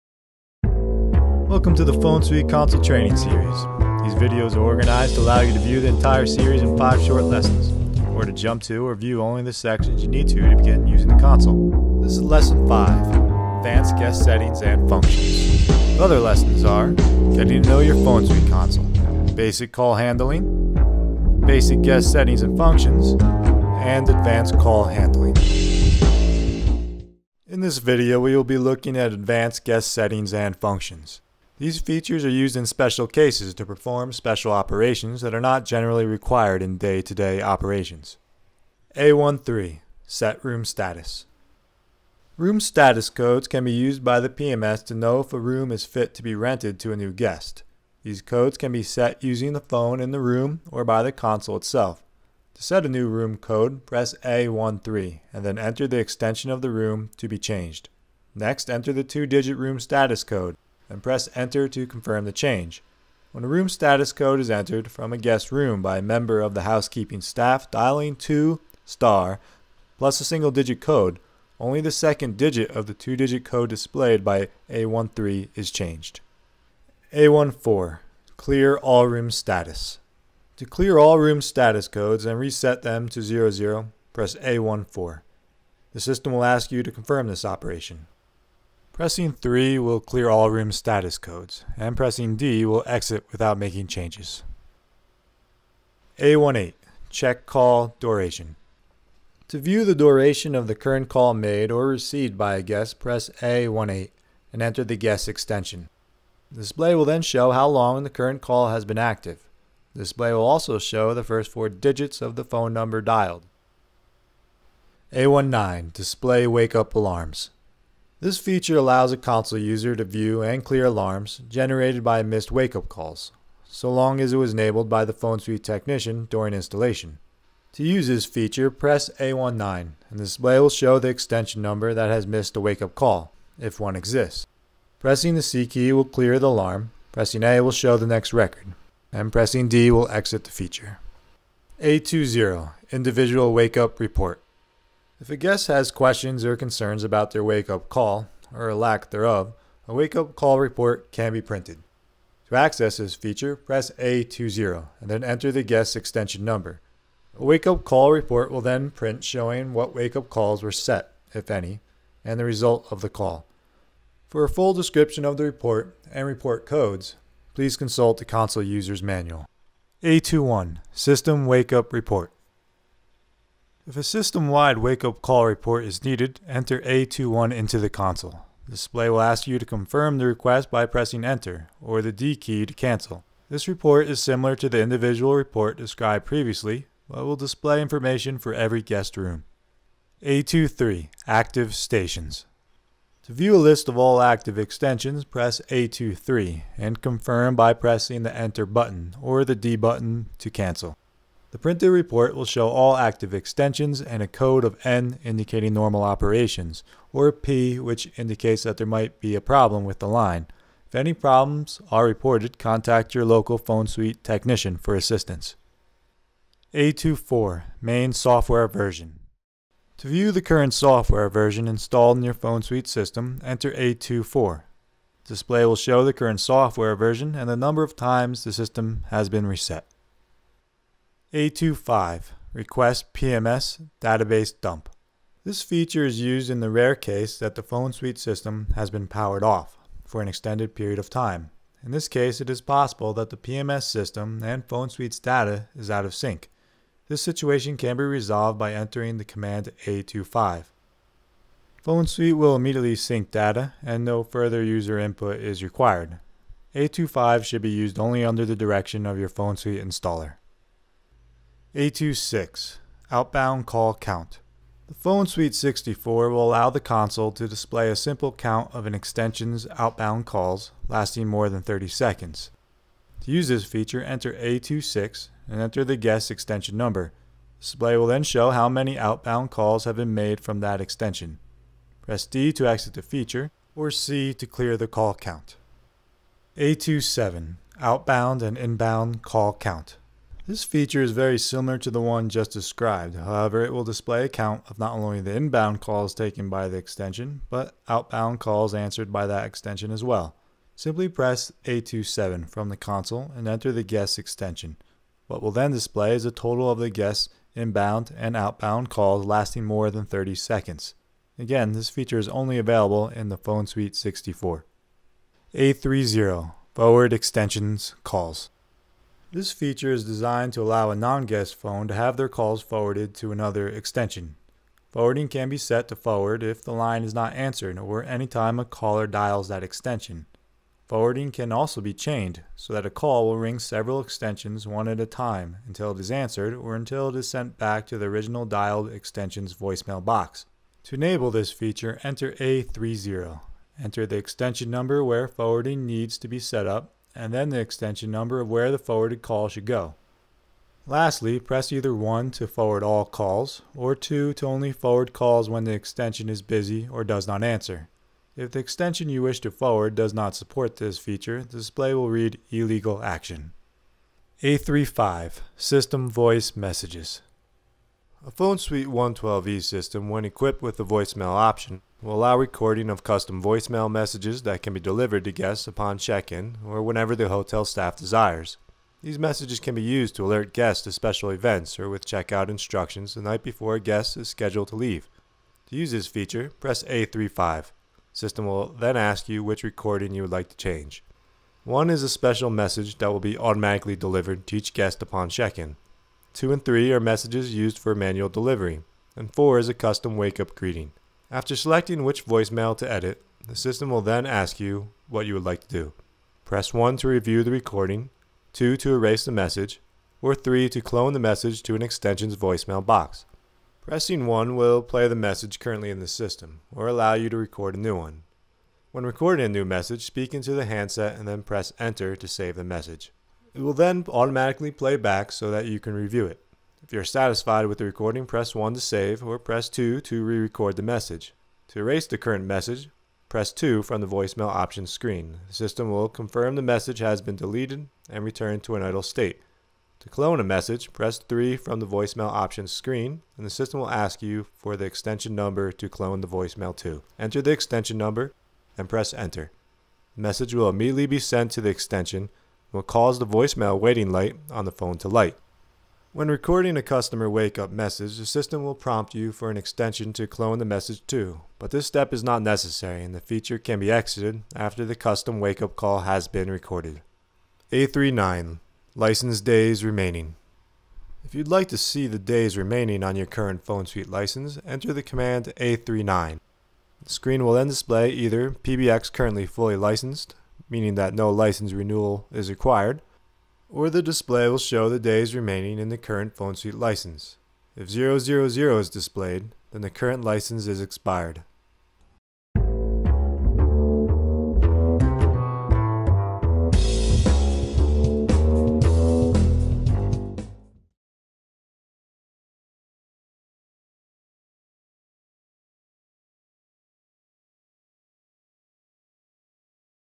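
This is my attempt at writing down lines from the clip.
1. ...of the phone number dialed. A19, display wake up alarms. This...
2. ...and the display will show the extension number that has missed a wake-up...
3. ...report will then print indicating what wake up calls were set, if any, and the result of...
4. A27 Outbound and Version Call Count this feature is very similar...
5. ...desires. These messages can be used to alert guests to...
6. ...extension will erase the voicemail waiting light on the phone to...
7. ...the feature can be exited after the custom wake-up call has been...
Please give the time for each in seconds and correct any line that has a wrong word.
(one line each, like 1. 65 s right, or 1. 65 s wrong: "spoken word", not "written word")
1. 112 s right
2. 129 s right
3. 158 s wrong: "showing", not "indicating"
4. 286 s wrong: "Inbound", not "Version"
5. 377 s right
6. 451 s wrong: "cause", not "erase"
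7. 463 s right.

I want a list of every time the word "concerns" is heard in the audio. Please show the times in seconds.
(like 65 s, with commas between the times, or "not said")
146 s.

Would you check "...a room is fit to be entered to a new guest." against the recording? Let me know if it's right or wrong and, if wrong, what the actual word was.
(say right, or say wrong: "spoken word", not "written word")
wrong: "rented", not "entered".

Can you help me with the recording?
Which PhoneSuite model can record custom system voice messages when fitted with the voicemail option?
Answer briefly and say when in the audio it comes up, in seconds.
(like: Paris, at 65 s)
PhoneSuite 112e, at 368 s.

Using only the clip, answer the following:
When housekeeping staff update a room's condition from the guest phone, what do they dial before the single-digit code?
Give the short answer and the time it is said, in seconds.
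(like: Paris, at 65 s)
2 star, at 68 s.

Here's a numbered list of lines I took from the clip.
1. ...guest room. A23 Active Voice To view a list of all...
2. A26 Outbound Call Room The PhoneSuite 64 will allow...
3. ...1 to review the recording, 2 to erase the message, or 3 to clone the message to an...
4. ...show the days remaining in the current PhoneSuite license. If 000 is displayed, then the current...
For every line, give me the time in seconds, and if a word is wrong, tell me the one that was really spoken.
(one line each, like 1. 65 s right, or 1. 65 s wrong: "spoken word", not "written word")
1. 188 s wrong: "Stations", not "Voice"
2. 261 s wrong: "Count", not "Room"
3. 406 s right
4. 484 s right.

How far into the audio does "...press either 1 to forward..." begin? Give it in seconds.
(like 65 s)
351 s.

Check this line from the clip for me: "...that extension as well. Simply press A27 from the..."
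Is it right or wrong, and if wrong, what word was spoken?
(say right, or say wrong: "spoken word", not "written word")
right.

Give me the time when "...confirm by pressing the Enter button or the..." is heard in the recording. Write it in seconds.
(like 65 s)
197 s.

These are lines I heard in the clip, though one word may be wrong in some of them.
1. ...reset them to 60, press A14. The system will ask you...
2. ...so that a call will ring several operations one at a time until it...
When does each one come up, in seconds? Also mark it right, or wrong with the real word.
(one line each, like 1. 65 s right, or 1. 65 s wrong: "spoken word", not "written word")
1. 82 s wrong: "00", not "60"
2. 332 s wrong: "extensions", not "operations".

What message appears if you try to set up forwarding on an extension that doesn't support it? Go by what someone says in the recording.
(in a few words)
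Illegal Action.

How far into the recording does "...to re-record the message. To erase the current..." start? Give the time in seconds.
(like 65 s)
430 s.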